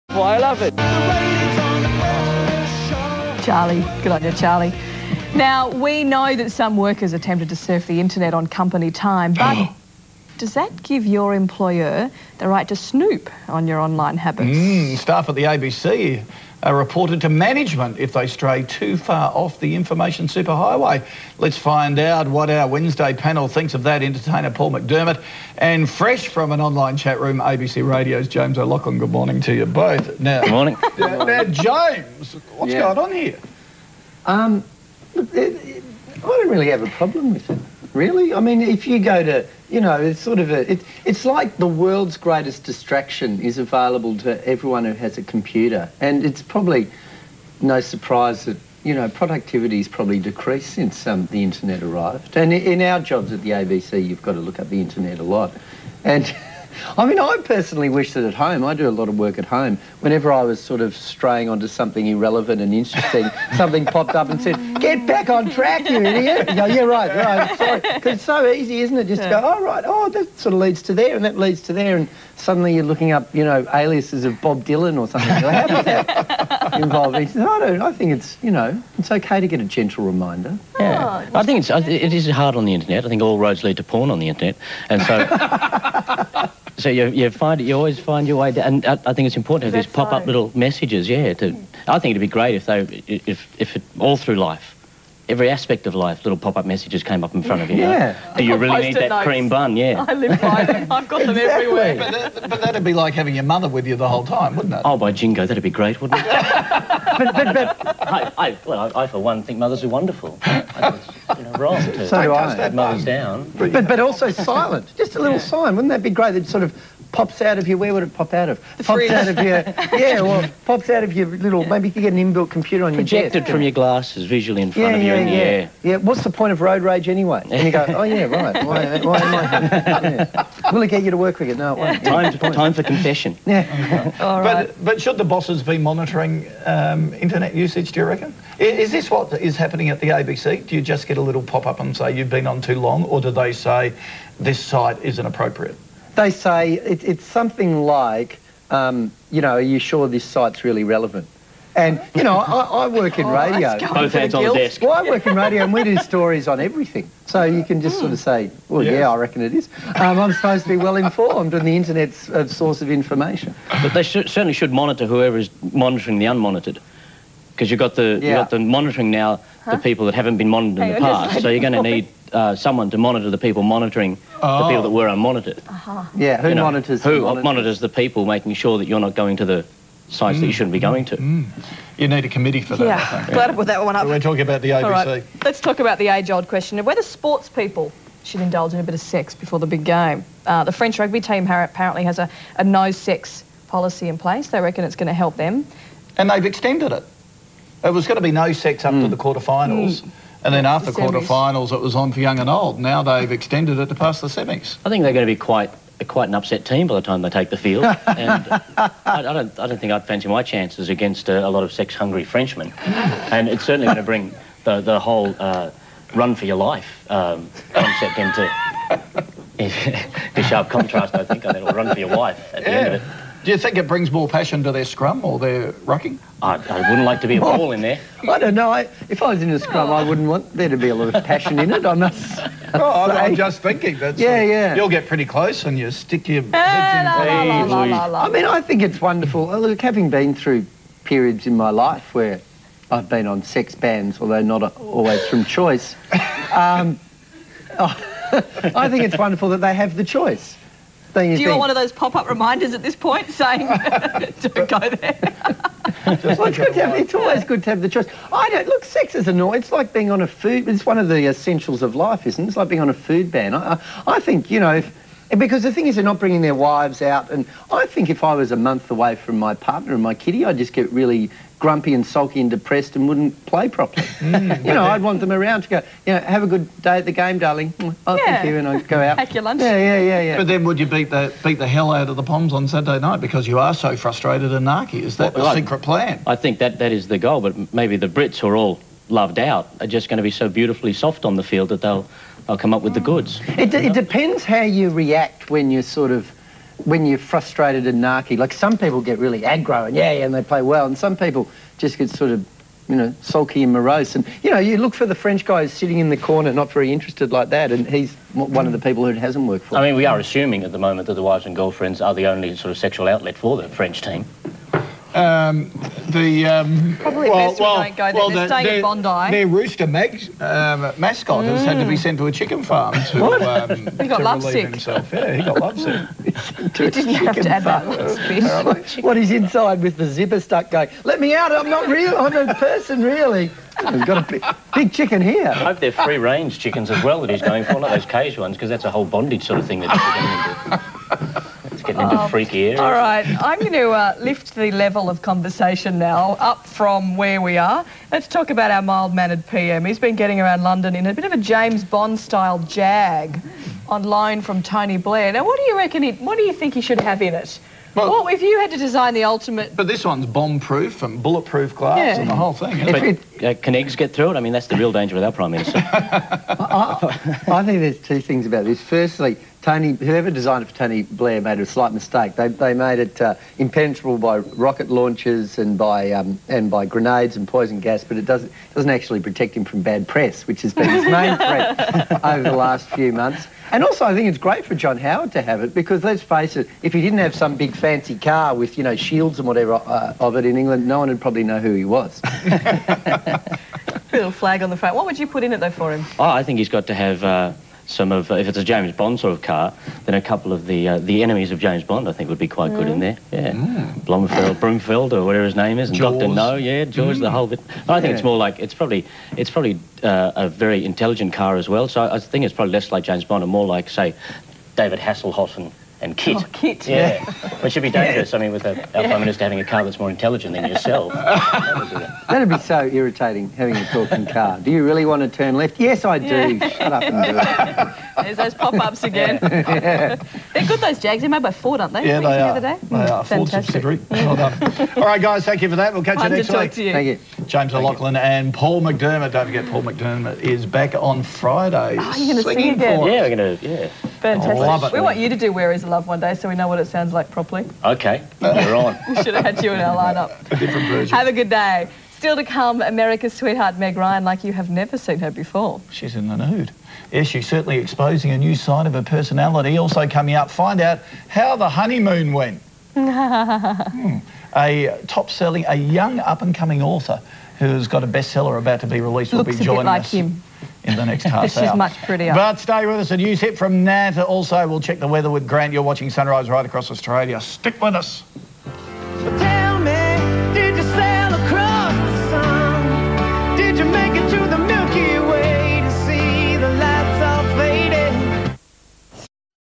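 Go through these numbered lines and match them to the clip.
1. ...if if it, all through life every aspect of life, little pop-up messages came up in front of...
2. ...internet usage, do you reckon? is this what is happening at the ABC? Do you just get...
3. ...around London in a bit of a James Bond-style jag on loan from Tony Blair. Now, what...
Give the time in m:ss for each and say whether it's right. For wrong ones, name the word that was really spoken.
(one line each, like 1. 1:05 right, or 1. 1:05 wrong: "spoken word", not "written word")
1. 1:33 right
2. 2:17 right
3. 5:50 right.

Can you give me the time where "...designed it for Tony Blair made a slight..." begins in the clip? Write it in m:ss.
6:10.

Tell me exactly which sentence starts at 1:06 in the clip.
You go, yeah, right, right, sorry.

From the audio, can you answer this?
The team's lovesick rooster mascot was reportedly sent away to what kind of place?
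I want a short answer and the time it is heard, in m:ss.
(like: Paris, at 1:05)
chicken farm, at 5:22.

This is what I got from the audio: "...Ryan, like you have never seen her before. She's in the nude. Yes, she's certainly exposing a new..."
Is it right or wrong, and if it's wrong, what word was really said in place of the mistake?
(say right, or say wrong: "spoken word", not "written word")
right.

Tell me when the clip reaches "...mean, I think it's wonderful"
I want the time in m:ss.
3:58.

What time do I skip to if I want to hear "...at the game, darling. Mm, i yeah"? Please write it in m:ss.
4:36.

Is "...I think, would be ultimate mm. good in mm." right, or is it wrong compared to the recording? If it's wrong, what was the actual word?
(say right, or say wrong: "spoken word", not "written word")
wrong: "quite", not "ultimate".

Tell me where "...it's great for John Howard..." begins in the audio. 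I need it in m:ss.
6:24.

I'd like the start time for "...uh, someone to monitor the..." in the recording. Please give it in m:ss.
2:52.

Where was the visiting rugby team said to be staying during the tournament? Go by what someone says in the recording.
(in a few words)
Bondi.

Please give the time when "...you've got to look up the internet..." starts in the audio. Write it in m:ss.
0:54.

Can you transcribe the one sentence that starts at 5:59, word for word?
But this one's bomb-proof and bulletproof glass yeah.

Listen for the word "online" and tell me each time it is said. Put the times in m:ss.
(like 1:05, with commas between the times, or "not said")
0:13, 0:26.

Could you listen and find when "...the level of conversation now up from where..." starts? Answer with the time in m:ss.
5:44.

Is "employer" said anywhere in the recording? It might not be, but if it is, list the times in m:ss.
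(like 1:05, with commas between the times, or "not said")
0:11.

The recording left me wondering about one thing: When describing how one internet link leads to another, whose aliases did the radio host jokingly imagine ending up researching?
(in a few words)
Bob Dylan.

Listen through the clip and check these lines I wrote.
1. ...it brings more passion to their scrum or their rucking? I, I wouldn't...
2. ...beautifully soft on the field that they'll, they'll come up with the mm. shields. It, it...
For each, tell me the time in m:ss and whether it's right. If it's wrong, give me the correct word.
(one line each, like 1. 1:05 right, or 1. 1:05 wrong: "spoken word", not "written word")
1. 3:43 right
2. 4:50 wrong: "goods", not "shields".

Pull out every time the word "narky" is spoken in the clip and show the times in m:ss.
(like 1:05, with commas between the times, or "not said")
4:44, 4:58.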